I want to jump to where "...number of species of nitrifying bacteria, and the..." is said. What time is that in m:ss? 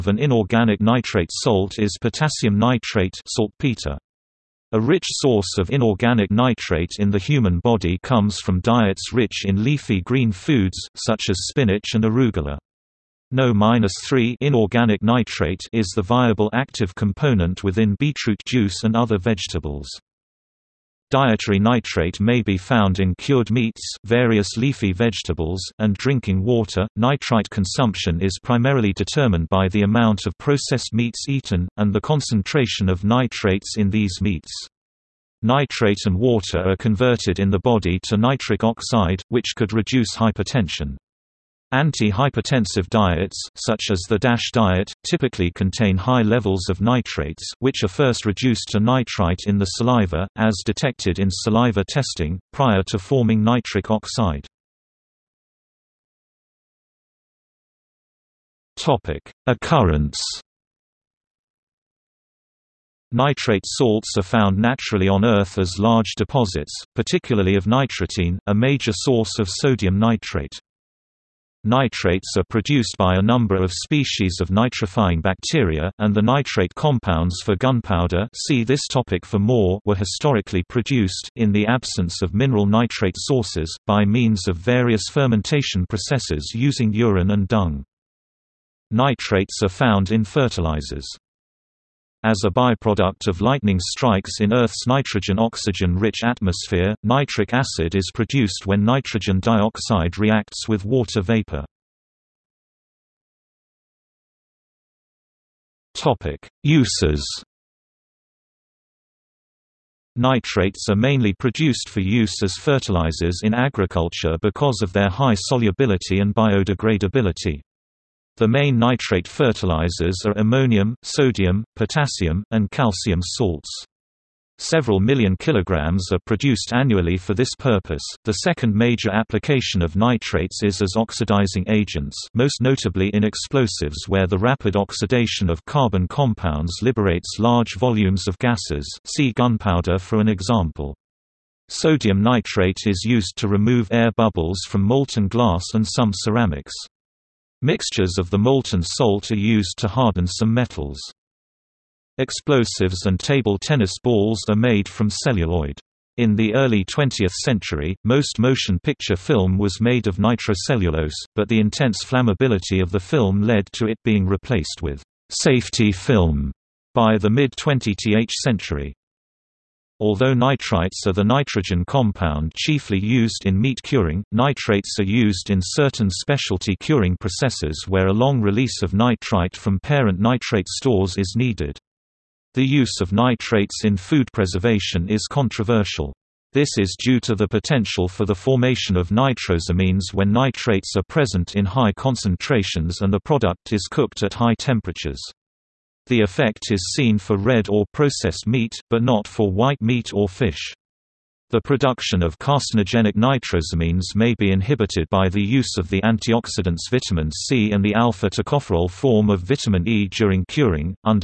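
1:13.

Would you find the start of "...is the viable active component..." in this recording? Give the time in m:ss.
0:15.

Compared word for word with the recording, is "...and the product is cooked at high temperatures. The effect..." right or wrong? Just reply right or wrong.
right.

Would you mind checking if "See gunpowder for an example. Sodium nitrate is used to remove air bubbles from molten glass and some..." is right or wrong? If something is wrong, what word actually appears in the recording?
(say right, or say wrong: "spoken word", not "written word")
right.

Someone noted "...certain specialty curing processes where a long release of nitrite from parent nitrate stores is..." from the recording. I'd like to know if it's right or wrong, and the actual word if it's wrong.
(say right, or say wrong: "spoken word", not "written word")
right.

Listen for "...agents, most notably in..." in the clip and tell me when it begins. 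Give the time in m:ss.
2:11.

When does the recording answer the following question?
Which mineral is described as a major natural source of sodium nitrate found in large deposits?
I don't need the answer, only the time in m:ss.
1:07.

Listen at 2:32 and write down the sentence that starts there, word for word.
Explosives and table tennis balls are made from celluloid.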